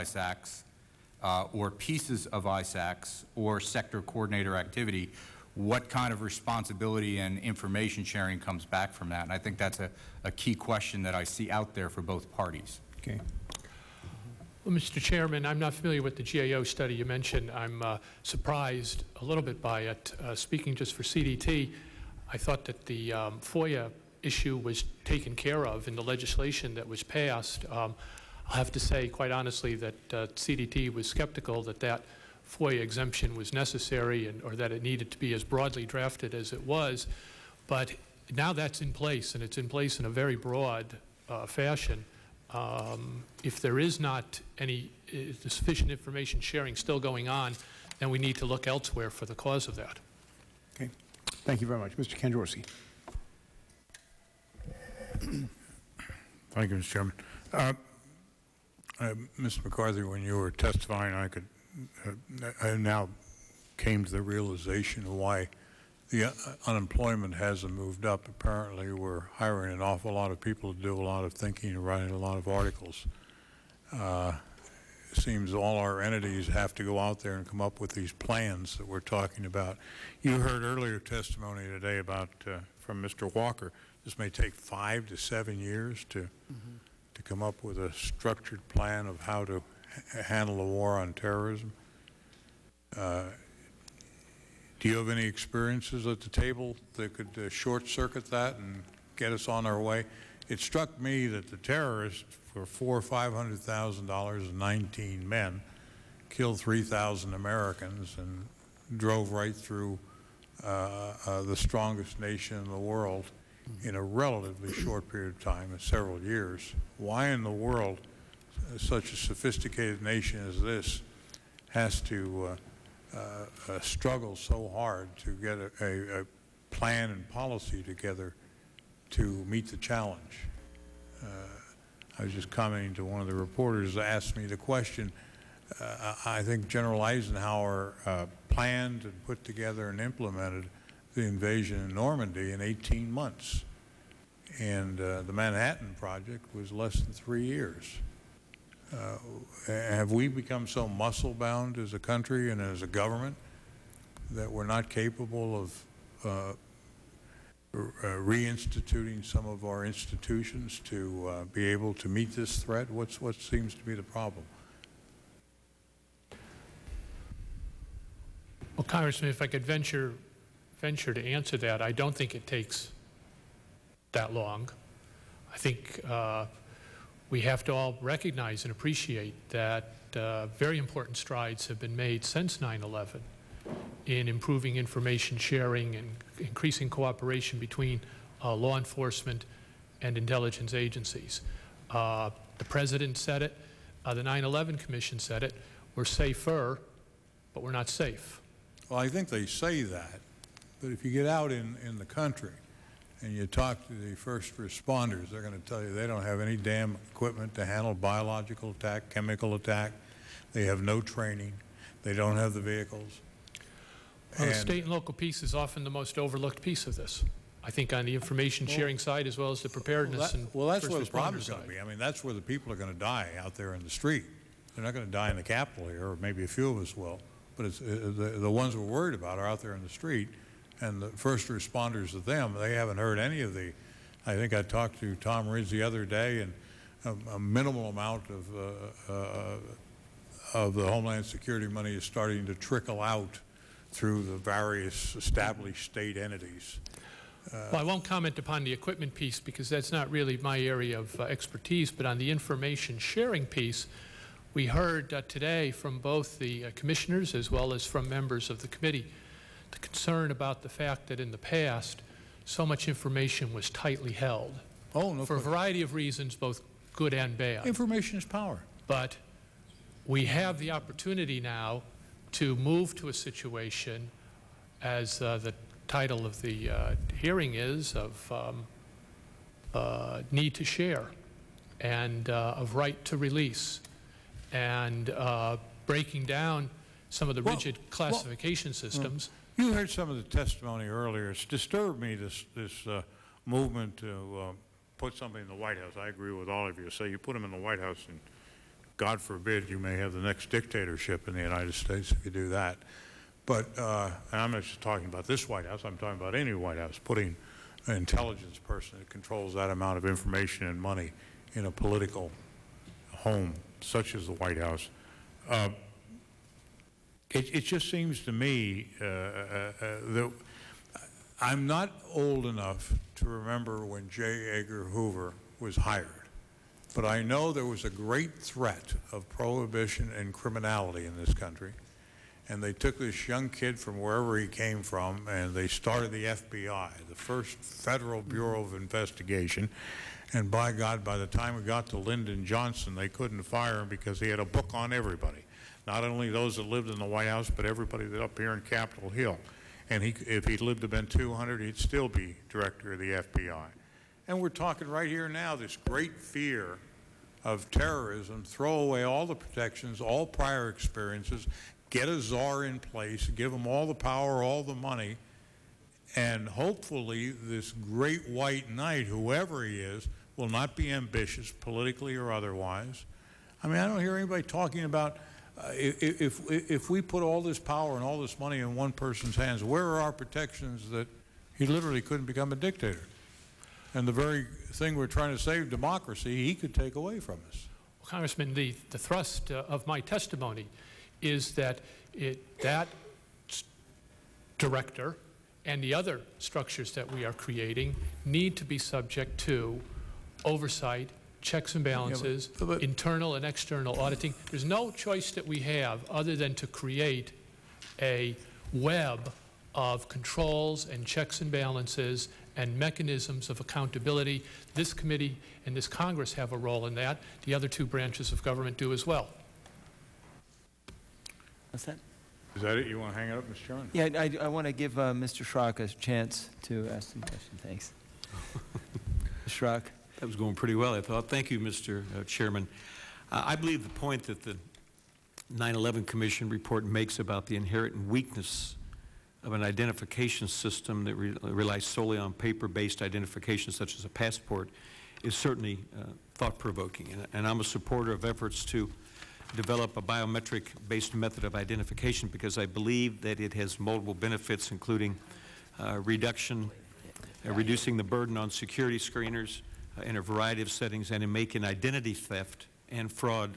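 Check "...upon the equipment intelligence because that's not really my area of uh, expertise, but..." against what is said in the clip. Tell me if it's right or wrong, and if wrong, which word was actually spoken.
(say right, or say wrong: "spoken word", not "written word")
wrong: "piece", not "intelligence".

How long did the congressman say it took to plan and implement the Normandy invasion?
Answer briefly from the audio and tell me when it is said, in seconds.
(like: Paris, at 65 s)
18 months, at 142 s.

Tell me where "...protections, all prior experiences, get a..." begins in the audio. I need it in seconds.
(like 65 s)
359 s.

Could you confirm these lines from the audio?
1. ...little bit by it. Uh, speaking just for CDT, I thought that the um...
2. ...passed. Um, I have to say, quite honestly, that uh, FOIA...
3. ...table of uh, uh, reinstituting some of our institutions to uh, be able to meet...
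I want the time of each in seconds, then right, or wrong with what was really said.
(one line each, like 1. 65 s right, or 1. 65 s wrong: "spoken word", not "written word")
1. 19 s right
2. 27 s wrong: "CDT", not "FOIA"
3. 154 s wrong: "capable", not "table".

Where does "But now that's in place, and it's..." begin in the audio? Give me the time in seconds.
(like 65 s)
37 s.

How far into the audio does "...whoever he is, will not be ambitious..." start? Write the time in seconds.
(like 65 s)
369 s.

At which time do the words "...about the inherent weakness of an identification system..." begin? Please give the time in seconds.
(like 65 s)
437 s.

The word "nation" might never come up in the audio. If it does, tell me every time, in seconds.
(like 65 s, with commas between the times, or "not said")
112 s, 120 s.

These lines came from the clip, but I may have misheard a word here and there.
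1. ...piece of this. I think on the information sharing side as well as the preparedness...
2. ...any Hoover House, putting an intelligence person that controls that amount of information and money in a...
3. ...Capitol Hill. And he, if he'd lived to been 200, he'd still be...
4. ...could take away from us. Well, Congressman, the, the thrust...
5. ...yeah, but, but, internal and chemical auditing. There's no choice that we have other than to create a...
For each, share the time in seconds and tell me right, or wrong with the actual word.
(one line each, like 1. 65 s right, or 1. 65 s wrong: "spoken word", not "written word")
1. 216 s right
2. 306 s wrong: "White", not "Hoover"
3. 348 s right
4. 386 s right
5. 402 s wrong: "external", not "chemical".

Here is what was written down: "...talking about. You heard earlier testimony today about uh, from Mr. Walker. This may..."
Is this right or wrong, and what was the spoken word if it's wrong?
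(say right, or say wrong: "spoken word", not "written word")
right.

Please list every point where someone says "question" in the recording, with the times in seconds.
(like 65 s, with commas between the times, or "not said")
10 s, 134 s, 265 s, 427 s.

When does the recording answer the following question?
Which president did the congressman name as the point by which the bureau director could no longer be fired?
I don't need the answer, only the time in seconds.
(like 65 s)
341 s.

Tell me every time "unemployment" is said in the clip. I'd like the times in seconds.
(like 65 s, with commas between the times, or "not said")
66 s.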